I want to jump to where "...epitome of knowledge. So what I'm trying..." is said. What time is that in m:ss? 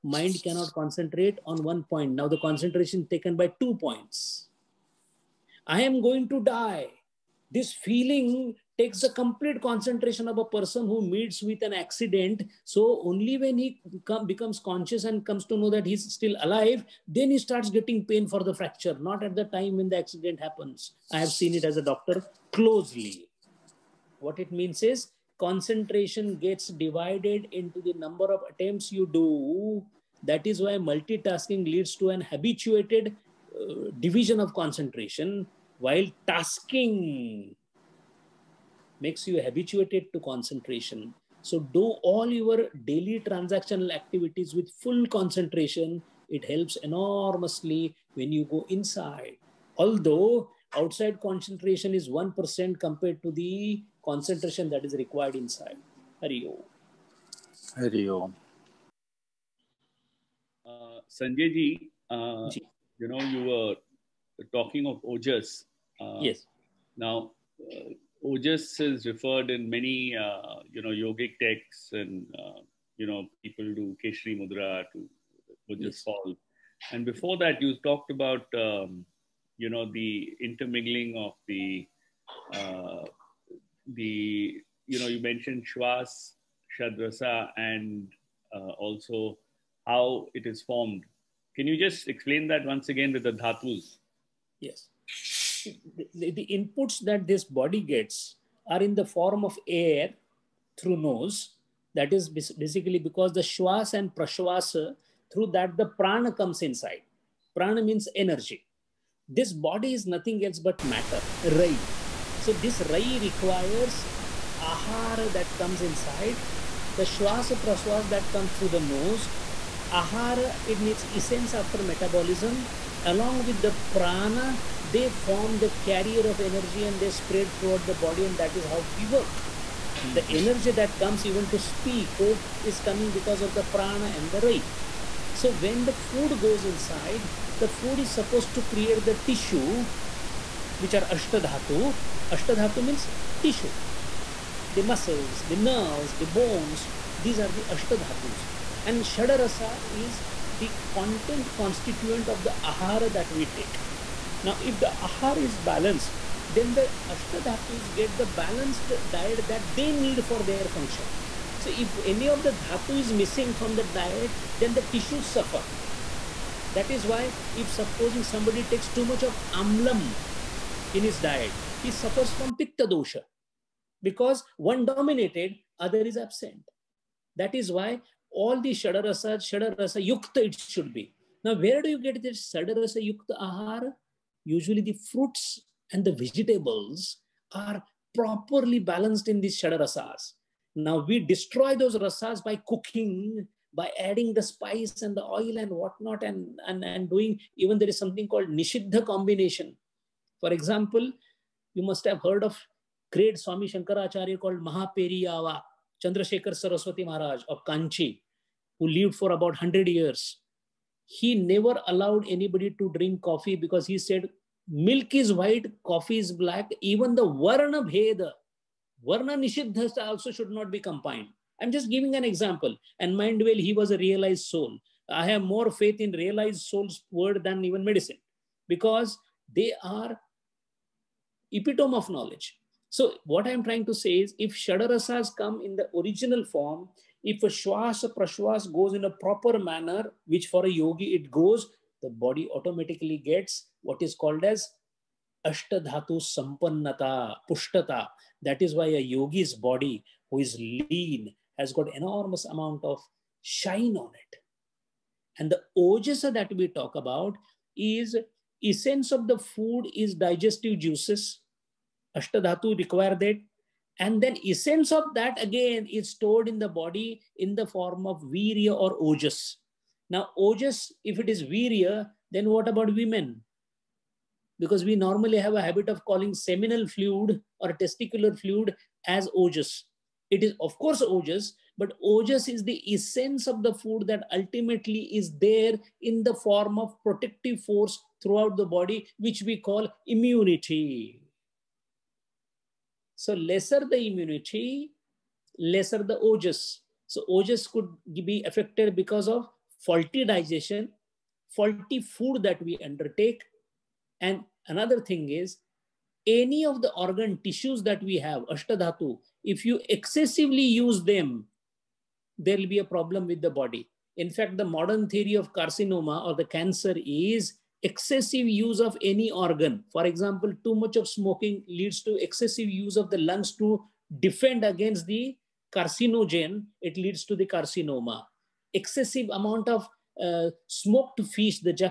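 3:51.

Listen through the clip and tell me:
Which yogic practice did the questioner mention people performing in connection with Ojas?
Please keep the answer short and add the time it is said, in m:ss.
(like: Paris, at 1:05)
Khechari Mudra, at 1:14.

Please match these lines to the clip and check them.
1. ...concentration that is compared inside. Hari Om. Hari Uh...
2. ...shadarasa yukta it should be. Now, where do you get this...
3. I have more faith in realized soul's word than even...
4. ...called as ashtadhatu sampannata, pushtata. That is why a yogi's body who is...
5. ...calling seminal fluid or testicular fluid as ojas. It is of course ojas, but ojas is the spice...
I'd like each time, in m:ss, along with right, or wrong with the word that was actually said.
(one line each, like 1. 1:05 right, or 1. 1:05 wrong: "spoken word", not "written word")
1. 0:54 wrong: "required", not "compared"
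2. 2:59 right
3. 3:45 right
4. 4:04 right
5. 4:36 wrong: "essence", not "spice".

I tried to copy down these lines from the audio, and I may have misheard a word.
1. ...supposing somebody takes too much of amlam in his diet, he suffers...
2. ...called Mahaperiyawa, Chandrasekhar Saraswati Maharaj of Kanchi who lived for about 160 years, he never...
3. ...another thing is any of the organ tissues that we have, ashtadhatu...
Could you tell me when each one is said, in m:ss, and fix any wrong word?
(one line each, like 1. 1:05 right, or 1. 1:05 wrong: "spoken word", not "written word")
1. 2:47 right
2. 3:24 wrong: "100", not "160"
3. 5:04 right.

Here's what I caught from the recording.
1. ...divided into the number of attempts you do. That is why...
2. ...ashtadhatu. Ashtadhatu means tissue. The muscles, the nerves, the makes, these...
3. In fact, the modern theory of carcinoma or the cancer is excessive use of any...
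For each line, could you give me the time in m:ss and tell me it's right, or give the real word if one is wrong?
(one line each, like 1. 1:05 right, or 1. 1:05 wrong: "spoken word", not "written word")
1. 0:26 right
2. 2:21 wrong: "bones", not "makes"
3. 5:14 right.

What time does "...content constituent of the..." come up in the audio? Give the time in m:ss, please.
2:30.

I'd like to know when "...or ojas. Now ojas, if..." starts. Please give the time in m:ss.
4:28.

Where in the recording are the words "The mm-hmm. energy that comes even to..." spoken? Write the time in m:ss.
2:10.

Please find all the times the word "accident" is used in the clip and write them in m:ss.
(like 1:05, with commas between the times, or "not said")
0:11, 0:19.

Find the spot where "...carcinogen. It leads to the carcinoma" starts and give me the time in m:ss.
5:25.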